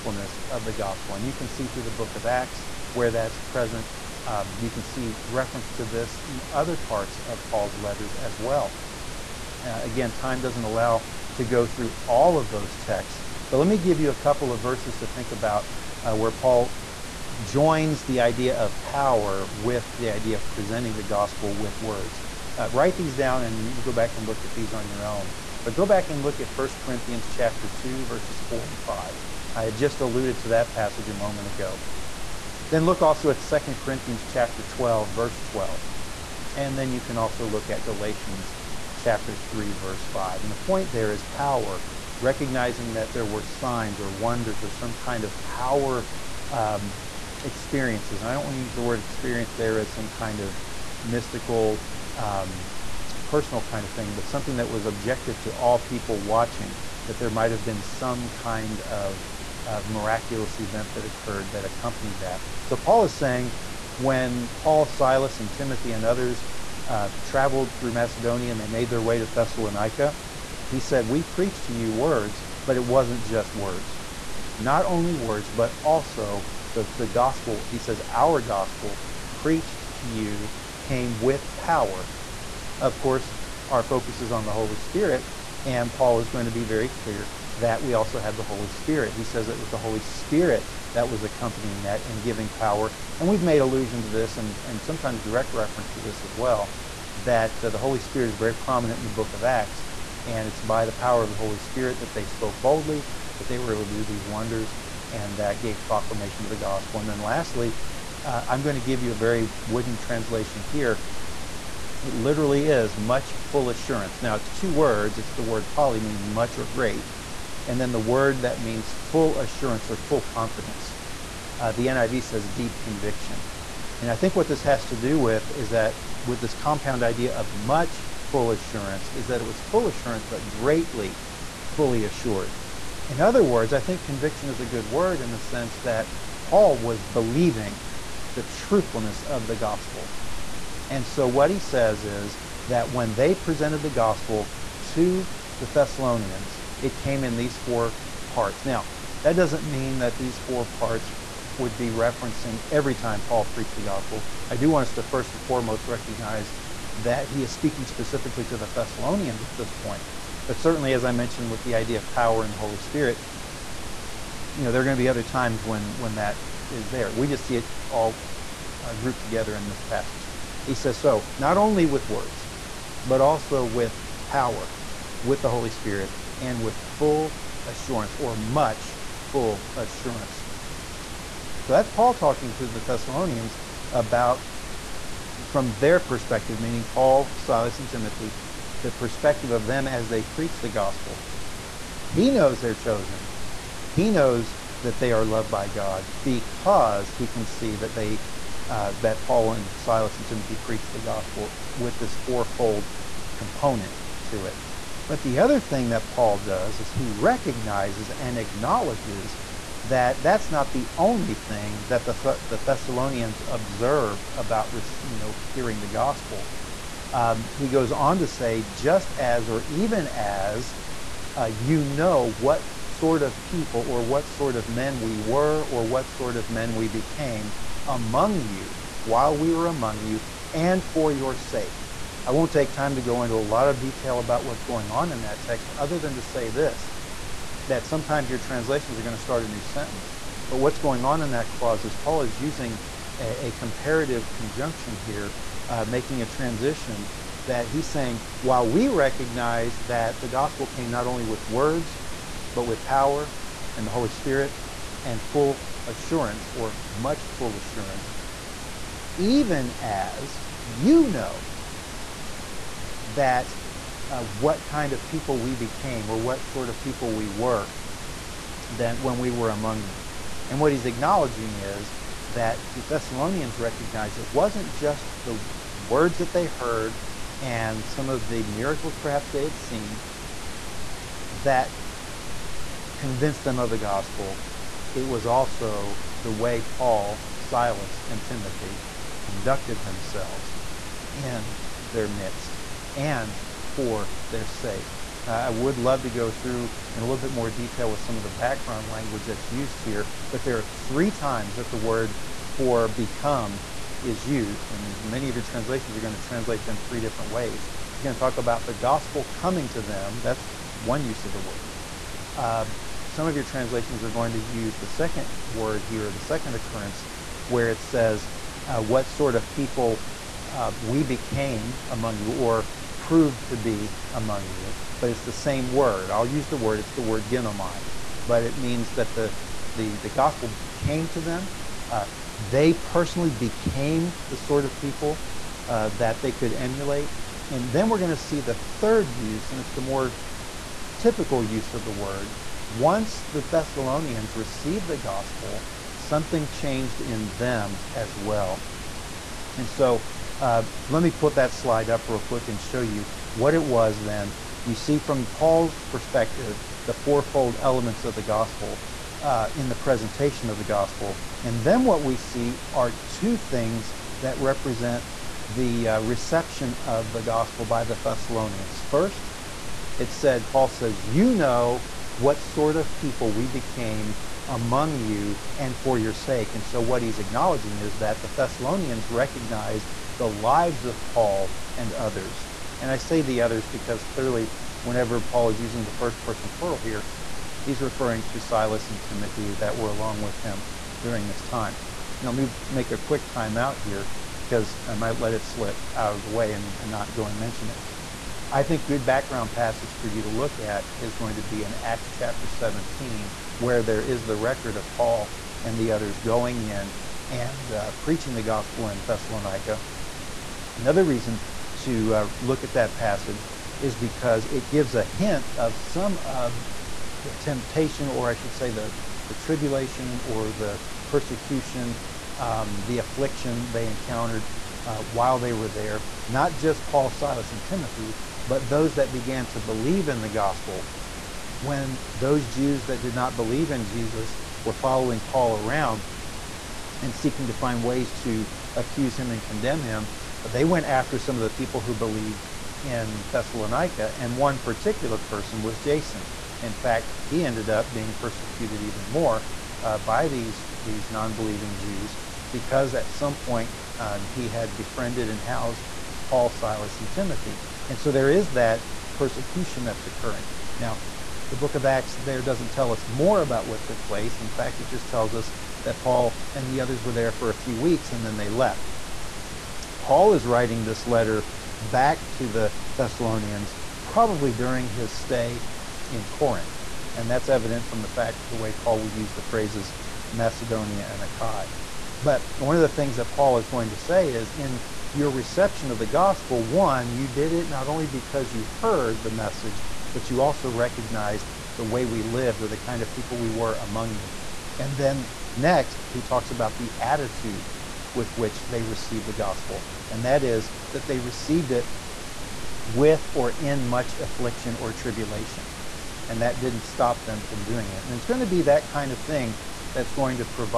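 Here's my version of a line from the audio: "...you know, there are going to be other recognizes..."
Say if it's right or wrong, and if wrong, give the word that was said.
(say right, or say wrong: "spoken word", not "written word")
wrong: "times", not "recognizes".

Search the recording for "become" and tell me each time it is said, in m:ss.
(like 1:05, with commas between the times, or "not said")
5:02.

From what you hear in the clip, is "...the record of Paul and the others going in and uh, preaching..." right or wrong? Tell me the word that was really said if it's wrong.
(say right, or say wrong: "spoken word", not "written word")
right.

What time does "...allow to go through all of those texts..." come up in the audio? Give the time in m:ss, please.
0:10.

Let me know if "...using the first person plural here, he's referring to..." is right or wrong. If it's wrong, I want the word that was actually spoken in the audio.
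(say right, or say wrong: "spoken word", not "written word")
right.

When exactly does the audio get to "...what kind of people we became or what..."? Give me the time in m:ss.
4:24.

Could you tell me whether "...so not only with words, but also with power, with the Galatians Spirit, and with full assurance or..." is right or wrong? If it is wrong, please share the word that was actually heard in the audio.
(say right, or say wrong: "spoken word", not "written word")
wrong: "Holy", not "Galatians".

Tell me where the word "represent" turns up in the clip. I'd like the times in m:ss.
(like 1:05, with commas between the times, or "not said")
6:04.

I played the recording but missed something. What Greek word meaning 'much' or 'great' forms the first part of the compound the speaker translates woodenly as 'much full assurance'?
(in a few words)
poly.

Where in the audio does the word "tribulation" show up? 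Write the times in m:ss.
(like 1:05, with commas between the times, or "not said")
6:59, 8:24.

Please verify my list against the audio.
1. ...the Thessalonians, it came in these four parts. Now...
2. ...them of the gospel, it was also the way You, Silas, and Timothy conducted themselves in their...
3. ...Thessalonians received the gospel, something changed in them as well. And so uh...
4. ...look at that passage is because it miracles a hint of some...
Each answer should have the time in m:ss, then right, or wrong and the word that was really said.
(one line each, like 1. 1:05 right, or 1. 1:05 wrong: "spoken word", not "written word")
1. 2:25 right
2. 4:43 wrong: "Paul", not "You"
3. 5:43 right
4. 6:52 wrong: "gives", not "miracles".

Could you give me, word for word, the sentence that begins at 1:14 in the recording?
Not only words, but also the, the gospel.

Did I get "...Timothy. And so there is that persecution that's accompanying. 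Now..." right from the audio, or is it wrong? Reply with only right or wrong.
wrong.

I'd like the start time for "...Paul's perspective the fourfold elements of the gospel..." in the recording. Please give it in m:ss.
5:55.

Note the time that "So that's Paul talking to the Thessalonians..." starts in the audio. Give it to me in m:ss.
3:01.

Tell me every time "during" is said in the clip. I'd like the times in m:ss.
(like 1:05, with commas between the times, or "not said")
6:31, 7:54.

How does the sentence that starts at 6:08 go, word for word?
First, it said, Paul says, You know what sort of people we became among you and for your sake.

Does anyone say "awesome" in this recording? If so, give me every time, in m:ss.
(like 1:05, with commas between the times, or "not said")
not said.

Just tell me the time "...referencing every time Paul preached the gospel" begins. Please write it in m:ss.
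2:31.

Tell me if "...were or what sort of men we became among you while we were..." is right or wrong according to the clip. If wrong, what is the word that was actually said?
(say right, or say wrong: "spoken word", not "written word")
right.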